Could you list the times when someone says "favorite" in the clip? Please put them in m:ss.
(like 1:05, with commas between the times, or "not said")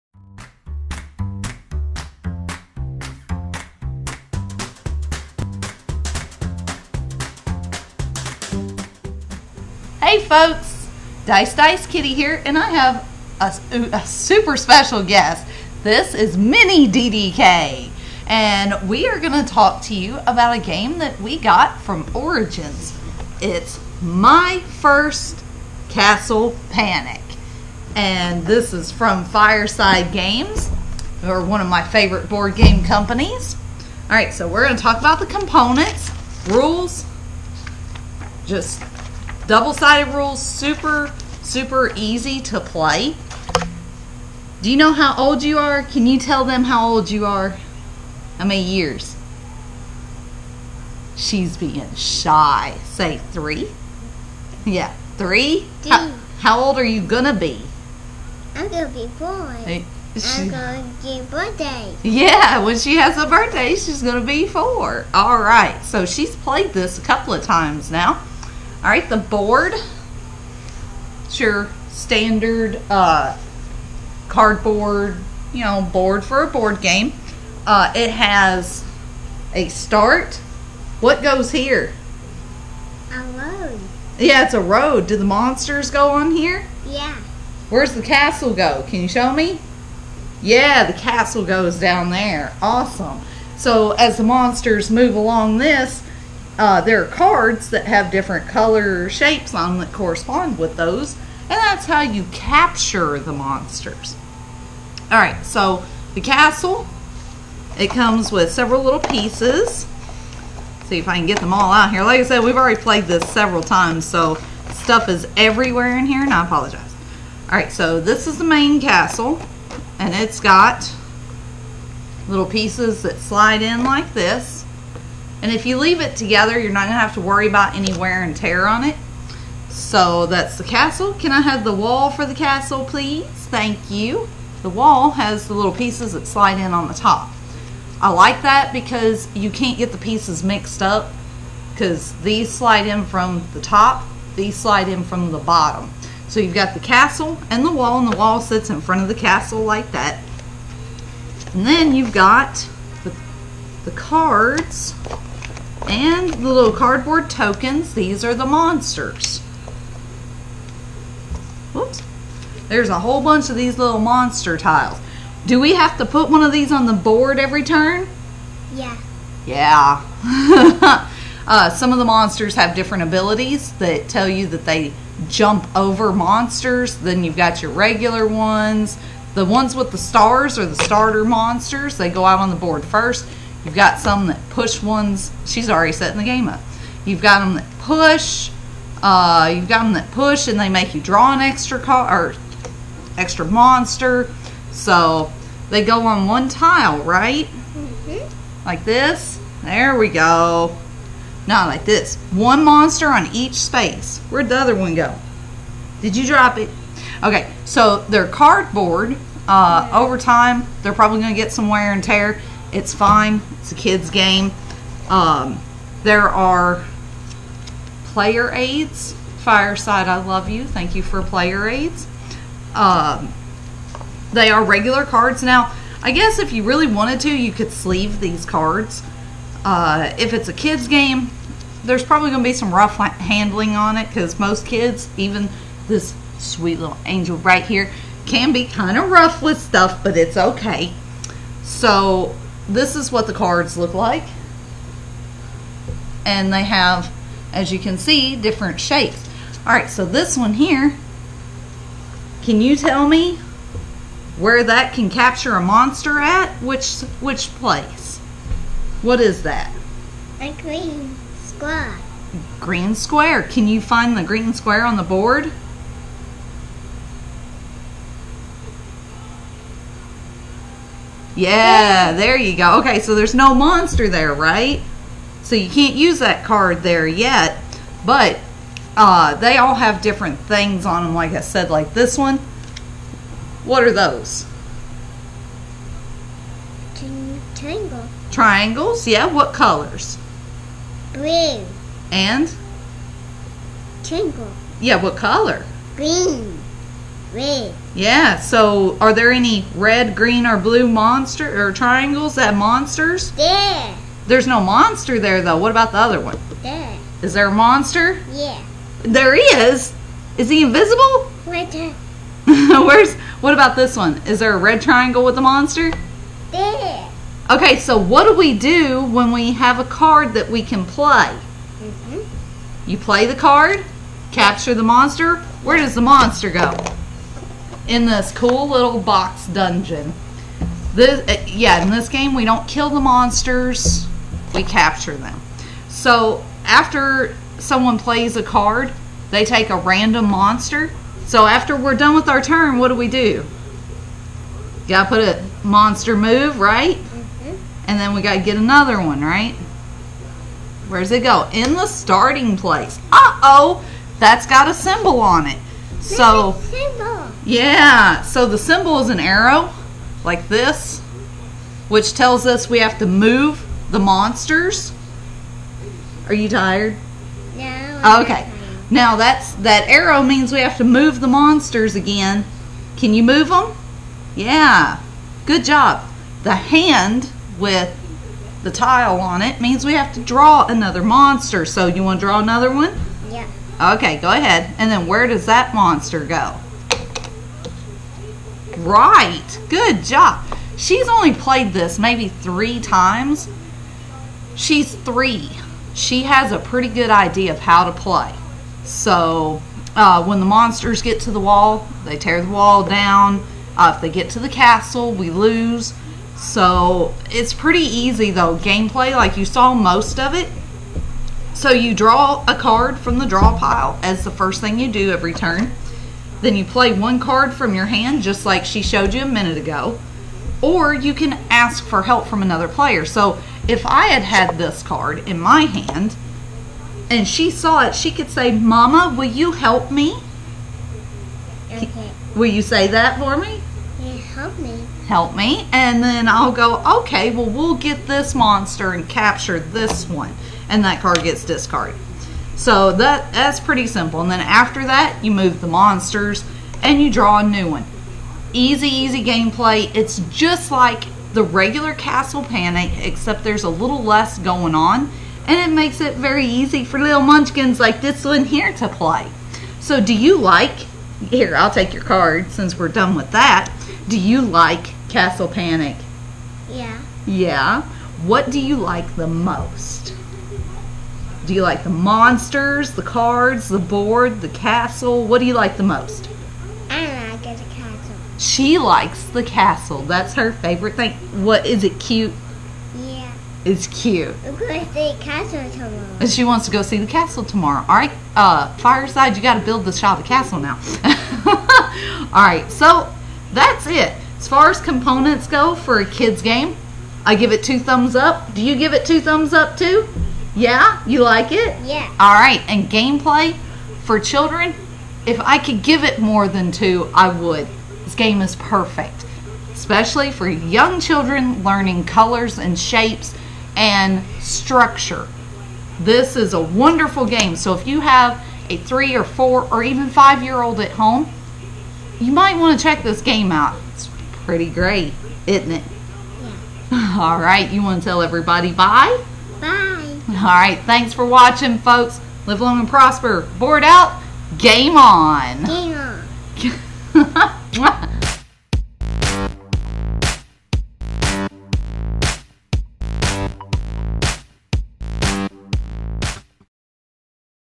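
0:31, 8:00.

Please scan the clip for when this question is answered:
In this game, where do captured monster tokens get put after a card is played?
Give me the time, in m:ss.
5:28.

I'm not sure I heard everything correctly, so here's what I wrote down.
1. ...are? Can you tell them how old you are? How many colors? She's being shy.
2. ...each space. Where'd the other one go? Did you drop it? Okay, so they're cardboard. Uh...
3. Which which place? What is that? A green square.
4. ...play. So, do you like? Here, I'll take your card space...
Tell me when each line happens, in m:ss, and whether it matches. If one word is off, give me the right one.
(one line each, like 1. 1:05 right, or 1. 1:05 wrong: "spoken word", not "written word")
1. 0:45 wrong: "years", not "colors"
2. 3:23 right
3. 4:16 right
4. 7:38 wrong: "since", not "space".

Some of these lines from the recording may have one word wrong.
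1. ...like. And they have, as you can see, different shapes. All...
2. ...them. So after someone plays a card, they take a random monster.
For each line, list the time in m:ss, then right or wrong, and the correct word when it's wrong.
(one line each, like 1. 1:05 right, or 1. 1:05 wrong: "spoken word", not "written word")
1. 4:03 right
2. 5:35 right.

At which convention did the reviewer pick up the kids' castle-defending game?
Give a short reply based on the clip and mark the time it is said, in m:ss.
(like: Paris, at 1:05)
Origins, at 0:22.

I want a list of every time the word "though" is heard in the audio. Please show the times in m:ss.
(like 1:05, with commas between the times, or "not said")
5:05, 6:48.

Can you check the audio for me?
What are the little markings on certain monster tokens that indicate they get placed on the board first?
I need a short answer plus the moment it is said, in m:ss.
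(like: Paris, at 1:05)
Stars, at 2:59.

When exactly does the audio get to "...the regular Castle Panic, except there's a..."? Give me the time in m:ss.
7:31.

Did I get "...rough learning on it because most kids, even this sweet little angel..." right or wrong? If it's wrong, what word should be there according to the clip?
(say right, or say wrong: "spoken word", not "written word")
wrong: "handling", not "learning".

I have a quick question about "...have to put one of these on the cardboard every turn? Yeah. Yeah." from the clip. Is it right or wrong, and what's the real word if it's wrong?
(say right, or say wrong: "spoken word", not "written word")
wrong: "board", not "cardboard".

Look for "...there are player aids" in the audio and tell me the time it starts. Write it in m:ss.
3:36.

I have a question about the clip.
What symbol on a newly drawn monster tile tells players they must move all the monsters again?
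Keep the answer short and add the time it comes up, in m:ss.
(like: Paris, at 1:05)
An arrow, at 5:59.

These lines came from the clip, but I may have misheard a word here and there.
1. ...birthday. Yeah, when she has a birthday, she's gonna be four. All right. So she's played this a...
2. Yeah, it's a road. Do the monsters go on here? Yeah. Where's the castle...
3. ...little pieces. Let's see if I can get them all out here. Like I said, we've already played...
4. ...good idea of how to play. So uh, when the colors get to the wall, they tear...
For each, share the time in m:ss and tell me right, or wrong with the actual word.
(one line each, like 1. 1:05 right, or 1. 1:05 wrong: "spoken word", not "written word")
1. 1:01 right
2. 1:24 right
3. 1:48 right
4. 6:36 wrong: "monsters", not "colors".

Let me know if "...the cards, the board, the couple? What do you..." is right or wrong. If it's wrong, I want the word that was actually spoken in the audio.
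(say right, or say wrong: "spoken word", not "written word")
wrong: "castle", not "couple".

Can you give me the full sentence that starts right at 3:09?
Uh, you've got them that push, and they make you draw an extra card or extra monster.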